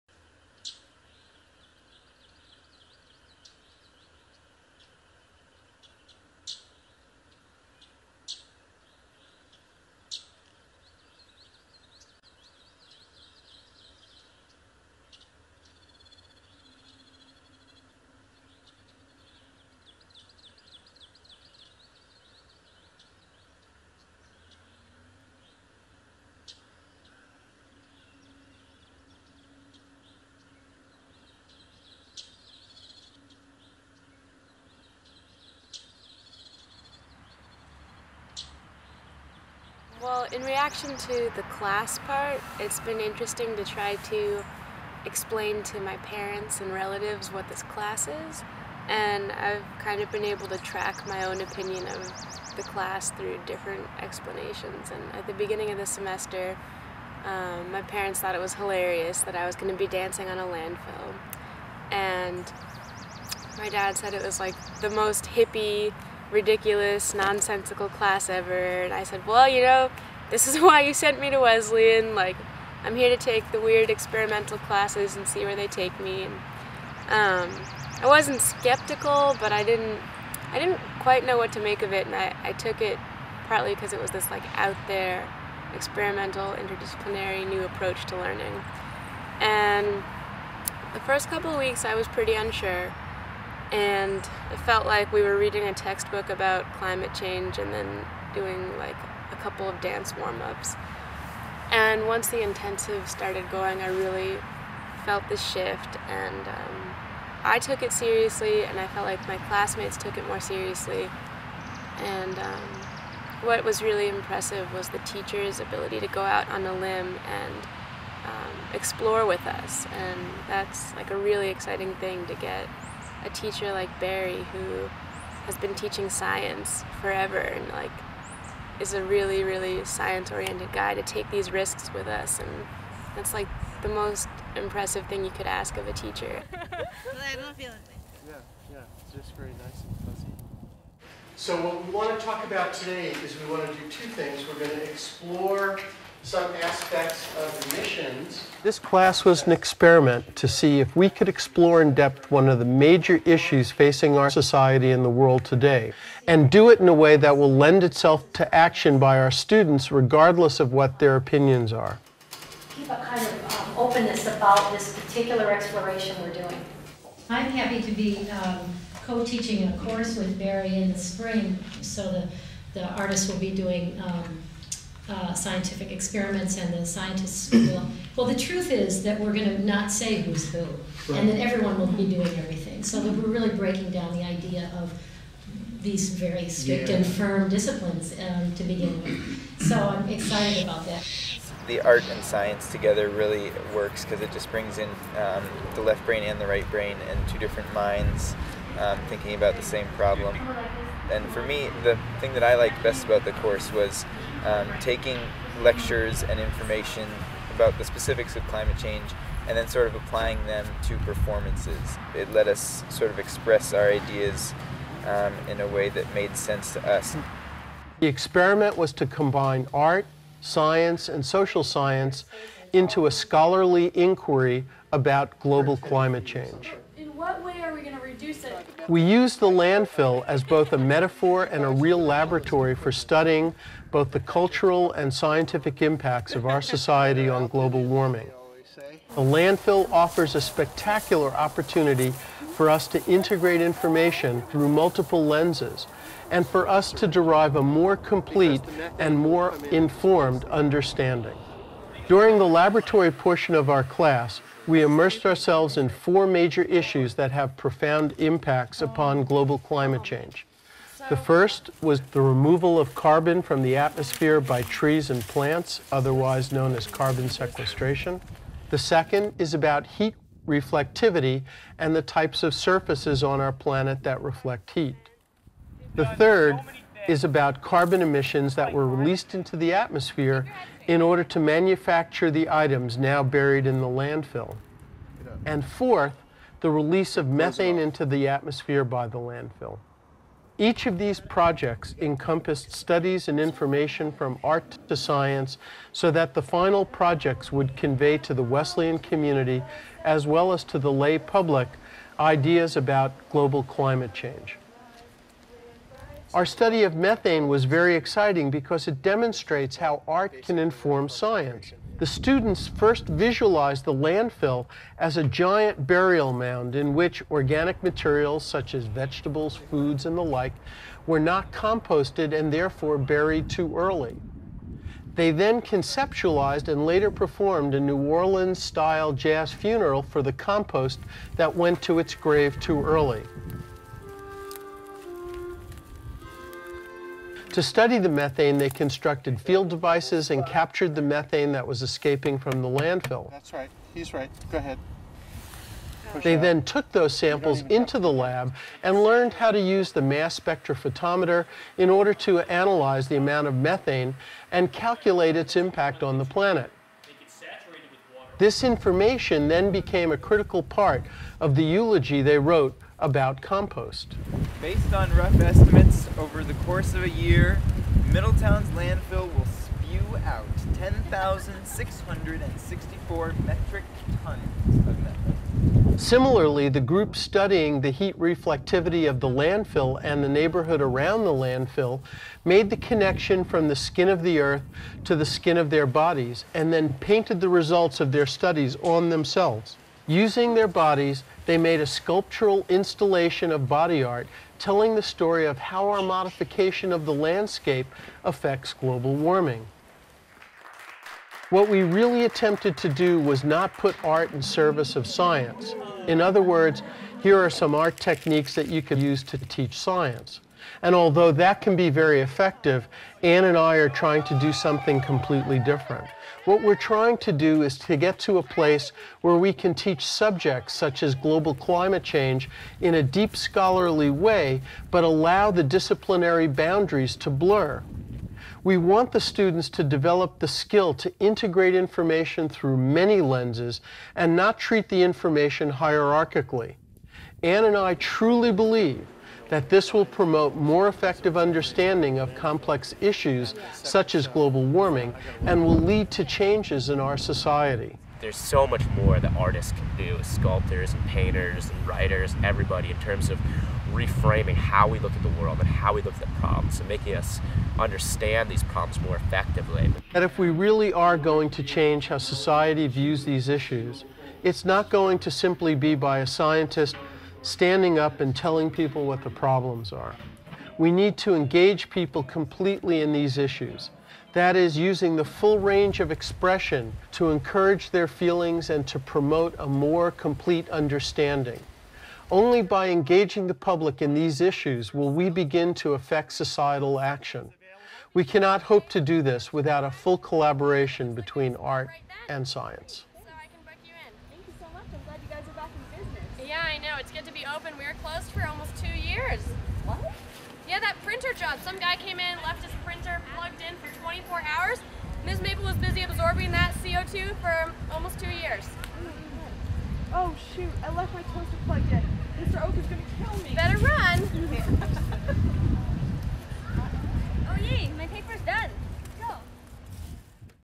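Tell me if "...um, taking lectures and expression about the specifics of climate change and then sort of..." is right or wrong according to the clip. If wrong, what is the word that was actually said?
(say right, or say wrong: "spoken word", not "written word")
wrong: "information", not "expression".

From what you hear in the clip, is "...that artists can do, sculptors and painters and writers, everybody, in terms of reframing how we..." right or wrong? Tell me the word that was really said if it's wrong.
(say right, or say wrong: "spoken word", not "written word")
right.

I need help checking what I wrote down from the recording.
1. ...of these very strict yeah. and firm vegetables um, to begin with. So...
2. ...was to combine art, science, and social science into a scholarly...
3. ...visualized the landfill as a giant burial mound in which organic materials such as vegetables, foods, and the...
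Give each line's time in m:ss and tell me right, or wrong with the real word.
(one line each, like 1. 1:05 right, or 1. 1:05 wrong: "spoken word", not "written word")
1. 3:04 wrong: "disciplines", not "vegetables"
2. 3:38 right
3. 5:13 right.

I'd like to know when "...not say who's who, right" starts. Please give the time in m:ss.
2:59.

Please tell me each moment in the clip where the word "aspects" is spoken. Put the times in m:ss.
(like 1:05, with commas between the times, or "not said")
2:26.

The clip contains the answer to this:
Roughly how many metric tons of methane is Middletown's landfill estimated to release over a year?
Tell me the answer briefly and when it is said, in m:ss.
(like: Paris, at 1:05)
10,664, at 6:10.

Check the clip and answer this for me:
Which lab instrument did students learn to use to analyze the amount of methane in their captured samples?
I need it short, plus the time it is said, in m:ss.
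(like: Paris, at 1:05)
Mass spectrophotometer, at 5:50.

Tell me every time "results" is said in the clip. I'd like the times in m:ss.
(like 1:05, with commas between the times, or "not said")
6:27.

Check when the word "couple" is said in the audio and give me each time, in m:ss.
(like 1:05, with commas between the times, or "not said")
1:31, 1:39.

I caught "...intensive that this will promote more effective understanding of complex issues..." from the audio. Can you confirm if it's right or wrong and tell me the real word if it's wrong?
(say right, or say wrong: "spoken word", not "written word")
wrong: "believe", not "intensive".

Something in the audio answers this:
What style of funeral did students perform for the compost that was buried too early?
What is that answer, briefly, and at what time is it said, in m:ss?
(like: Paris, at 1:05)
New Orleans-style jazz funeral, at 5:27.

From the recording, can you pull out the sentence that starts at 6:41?
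What we really attempted to do was not put art in service of science.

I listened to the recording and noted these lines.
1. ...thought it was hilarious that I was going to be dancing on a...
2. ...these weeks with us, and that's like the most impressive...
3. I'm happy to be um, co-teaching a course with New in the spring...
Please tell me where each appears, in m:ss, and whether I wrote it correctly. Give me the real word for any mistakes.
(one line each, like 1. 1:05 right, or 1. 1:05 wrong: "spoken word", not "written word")
1. 0:58 right
2. 2:11 wrong: "risks", not "weeks"
3. 2:47 wrong: "Barry", not "New".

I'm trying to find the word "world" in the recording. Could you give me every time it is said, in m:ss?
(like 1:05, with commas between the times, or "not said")
2:35, 7:35.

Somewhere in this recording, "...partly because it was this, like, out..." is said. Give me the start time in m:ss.
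1:23.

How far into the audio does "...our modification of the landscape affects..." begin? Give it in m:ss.
6:35.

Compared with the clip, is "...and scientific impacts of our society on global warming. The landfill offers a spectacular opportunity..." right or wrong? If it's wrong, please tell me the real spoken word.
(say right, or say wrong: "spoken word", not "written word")
right.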